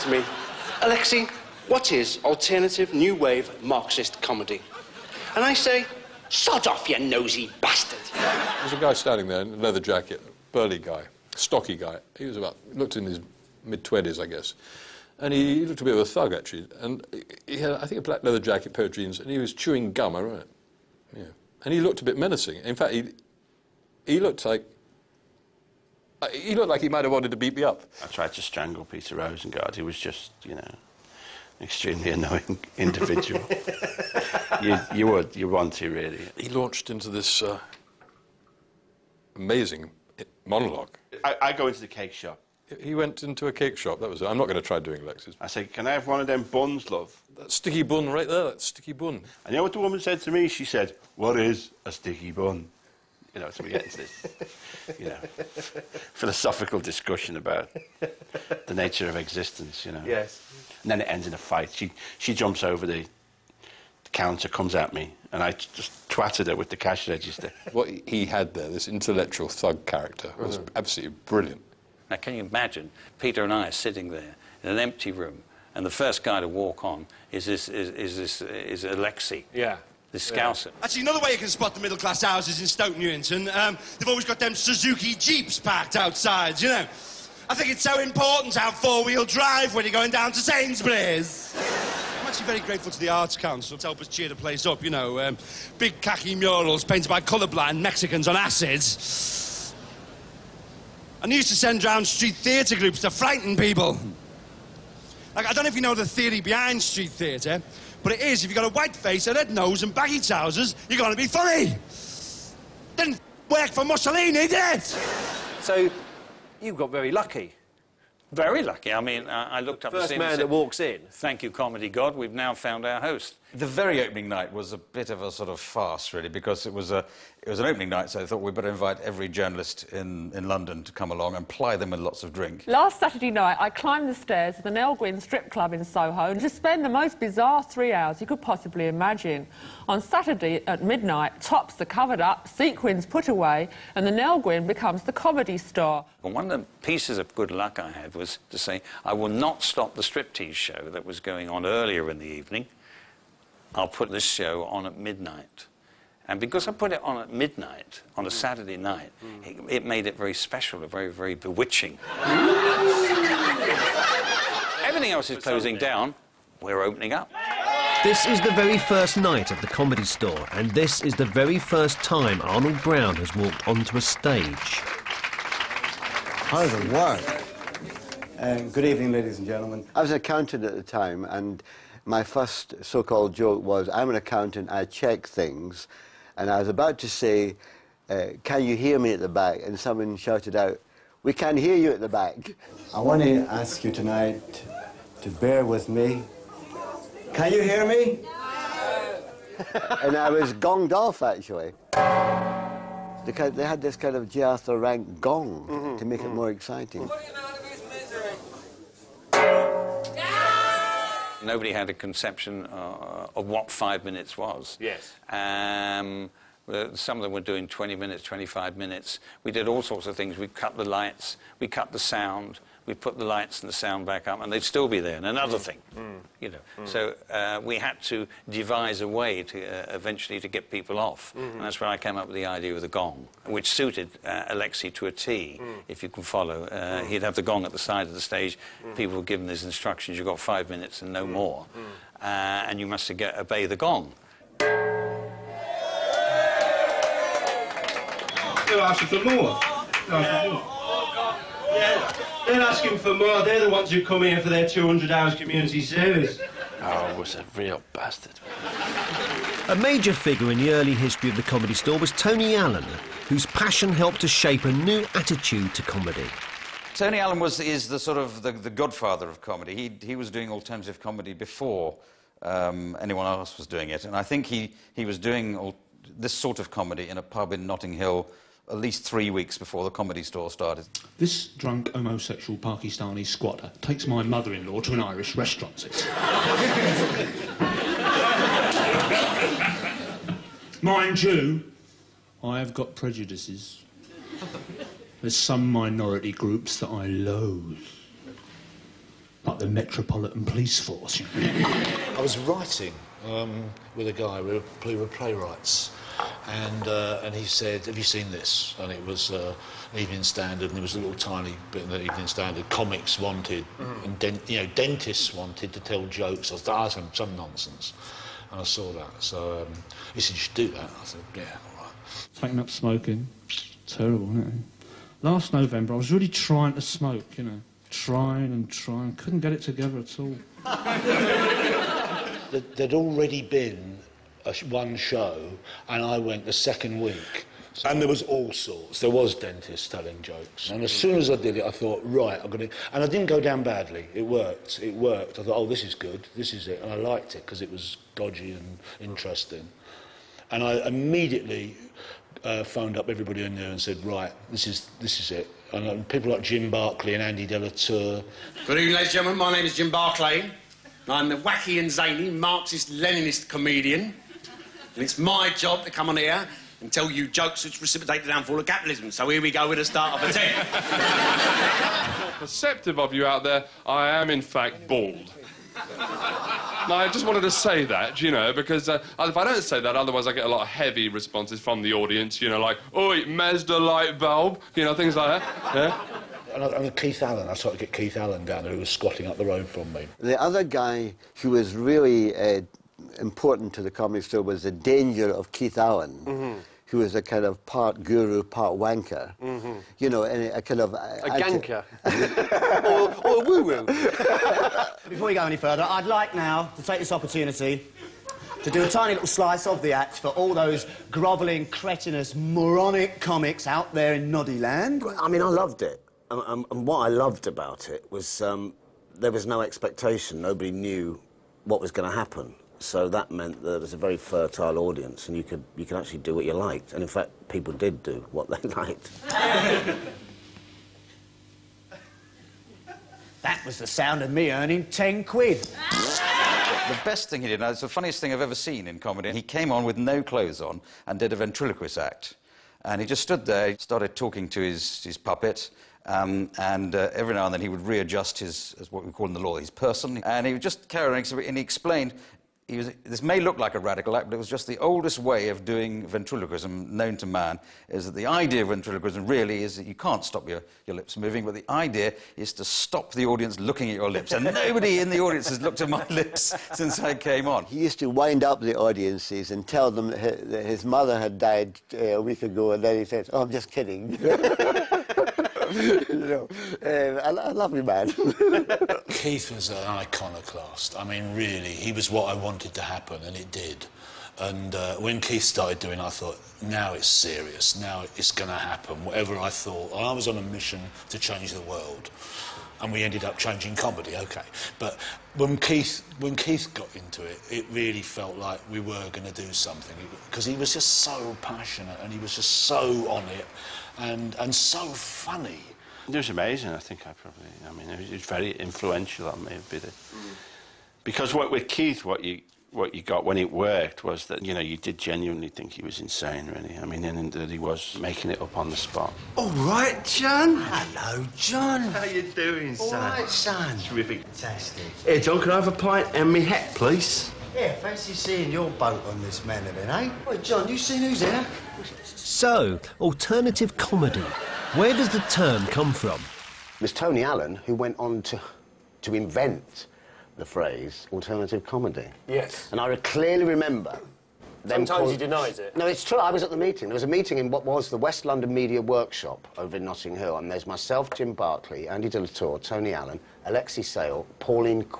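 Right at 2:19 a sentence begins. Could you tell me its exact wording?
On Saturday at midnight, tops are covered up, sequins put away, and the Nell Gwynn becomes the comedy star.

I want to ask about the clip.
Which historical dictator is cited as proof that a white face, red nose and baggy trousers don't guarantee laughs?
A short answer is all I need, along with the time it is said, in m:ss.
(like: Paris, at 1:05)
Mussolini, at 1:53.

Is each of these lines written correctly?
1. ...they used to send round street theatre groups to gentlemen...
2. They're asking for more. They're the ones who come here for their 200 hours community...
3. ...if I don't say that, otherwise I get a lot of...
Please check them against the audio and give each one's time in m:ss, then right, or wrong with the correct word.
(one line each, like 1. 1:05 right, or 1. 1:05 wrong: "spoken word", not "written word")
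1. 1:41 wrong: "frighten", not "gentlemen"
2. 4:12 right
3. 6:19 right.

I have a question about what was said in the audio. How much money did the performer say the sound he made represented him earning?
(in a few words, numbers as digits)
10 quid.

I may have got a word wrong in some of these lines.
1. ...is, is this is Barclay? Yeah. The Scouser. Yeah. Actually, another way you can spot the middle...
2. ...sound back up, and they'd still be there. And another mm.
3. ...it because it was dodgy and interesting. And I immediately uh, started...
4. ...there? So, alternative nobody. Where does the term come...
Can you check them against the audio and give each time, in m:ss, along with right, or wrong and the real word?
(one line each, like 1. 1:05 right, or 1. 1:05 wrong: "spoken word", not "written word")
1. 1:17 wrong: "Alexei", not "Barclay"
2. 3:43 right
3. 5:47 wrong: "phoned", not "started"
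4. 8:51 wrong: "comedy", not "nobody".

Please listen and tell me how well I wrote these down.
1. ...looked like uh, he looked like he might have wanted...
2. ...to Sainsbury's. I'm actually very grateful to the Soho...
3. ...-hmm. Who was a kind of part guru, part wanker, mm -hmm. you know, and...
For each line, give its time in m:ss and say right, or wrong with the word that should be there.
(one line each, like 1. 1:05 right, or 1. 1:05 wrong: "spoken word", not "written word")
1. 0:24 right
2. 1:30 wrong: "Arts", not "Soho"
3. 6:36 right.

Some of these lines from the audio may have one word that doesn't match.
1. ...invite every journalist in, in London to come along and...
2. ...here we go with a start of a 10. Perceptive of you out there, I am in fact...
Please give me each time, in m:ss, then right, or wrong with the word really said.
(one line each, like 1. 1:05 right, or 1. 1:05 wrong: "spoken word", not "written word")
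1. 2:08 right
2. 6:09 right.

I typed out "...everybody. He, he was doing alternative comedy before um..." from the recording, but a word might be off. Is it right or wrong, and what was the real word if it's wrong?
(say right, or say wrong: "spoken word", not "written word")
wrong: "comedy", not "everybody".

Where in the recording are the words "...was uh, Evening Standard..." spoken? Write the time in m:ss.
5:09.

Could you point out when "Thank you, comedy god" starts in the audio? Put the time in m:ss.
2:01.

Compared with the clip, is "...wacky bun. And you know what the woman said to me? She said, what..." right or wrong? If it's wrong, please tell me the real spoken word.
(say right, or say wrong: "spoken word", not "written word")
wrong: "sticky", not "wacky".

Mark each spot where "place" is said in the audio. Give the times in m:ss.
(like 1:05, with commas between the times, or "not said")
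1:34.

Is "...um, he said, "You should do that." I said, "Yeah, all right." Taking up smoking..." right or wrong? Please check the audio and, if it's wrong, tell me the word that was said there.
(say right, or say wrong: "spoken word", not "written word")
right.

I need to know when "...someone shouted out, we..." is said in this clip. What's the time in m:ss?
3:09.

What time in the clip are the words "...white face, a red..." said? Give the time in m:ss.
1:48.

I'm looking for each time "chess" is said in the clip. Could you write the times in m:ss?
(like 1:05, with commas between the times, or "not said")
not said.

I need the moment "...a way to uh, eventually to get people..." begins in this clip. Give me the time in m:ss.
3:49.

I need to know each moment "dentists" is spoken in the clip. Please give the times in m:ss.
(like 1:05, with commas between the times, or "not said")
5:14, 5:39.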